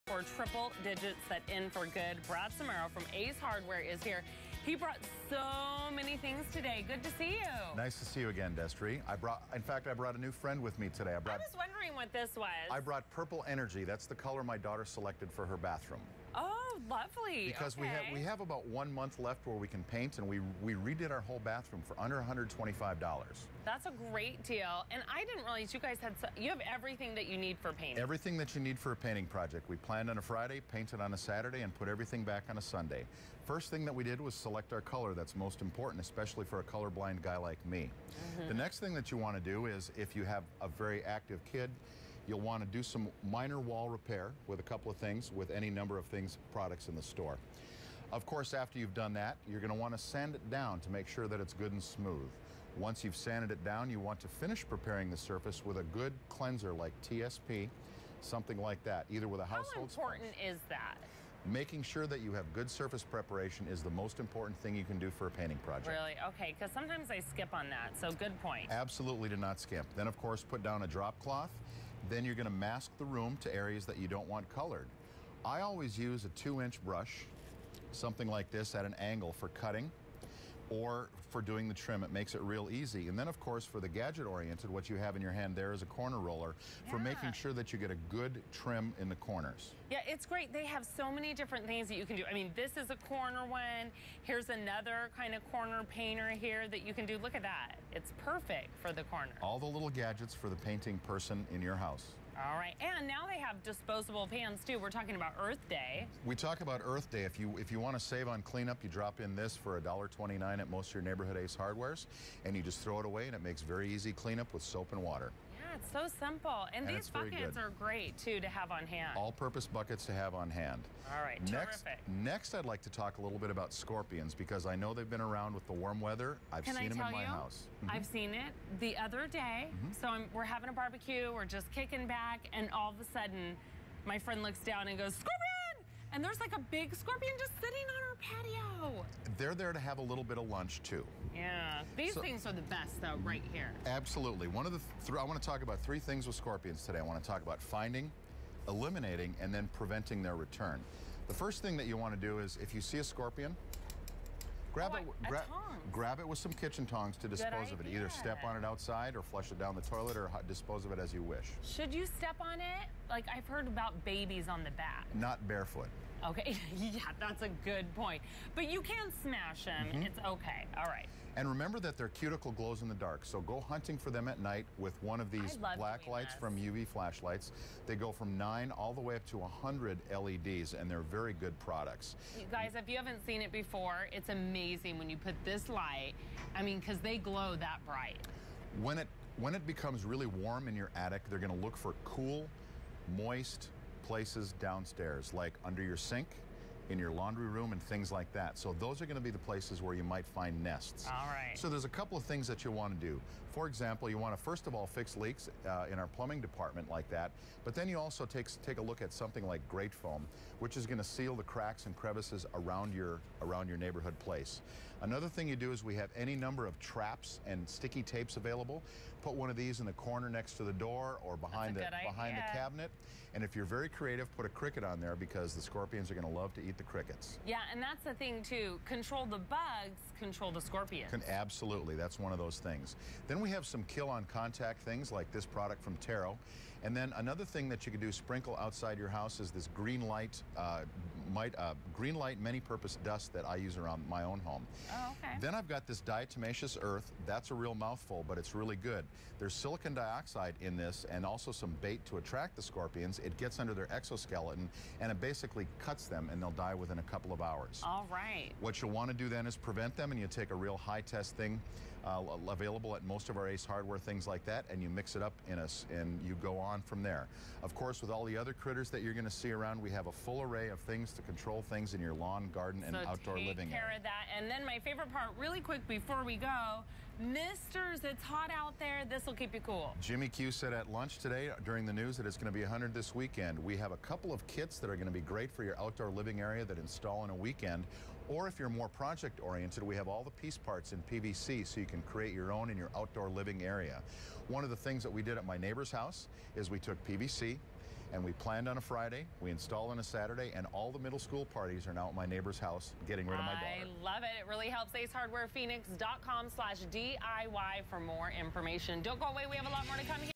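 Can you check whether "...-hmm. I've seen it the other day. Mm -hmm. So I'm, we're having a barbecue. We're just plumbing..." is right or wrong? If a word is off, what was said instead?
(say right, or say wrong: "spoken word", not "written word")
wrong: "kicking", not "plumbing".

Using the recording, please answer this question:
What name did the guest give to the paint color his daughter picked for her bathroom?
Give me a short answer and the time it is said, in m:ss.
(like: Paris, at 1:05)
Purple Energy, at 0:13.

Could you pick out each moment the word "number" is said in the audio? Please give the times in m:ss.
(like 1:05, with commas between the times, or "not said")
0:45, 3:36.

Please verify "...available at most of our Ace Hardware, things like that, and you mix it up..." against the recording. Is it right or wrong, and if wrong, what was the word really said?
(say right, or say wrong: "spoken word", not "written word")
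right.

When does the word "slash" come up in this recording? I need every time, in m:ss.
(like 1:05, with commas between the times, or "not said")
5:06.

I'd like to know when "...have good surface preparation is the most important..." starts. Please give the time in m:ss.
1:02.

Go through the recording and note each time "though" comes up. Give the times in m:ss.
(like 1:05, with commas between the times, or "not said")
2:23.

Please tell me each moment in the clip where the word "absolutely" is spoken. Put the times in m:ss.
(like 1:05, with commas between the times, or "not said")
1:08, 2:23, 3:51.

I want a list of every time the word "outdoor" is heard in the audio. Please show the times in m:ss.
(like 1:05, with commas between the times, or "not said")
4:33, 4:45, 4:52.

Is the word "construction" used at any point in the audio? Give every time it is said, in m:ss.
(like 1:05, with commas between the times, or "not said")
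not said.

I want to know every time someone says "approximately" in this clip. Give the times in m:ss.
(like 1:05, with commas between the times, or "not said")
not said.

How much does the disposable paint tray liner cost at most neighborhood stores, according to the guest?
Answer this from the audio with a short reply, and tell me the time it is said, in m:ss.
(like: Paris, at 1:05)
$1.29, at 1:49.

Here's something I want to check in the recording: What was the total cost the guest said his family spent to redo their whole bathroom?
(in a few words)
under $125.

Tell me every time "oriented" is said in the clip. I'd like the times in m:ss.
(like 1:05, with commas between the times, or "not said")
1:23, 4:49.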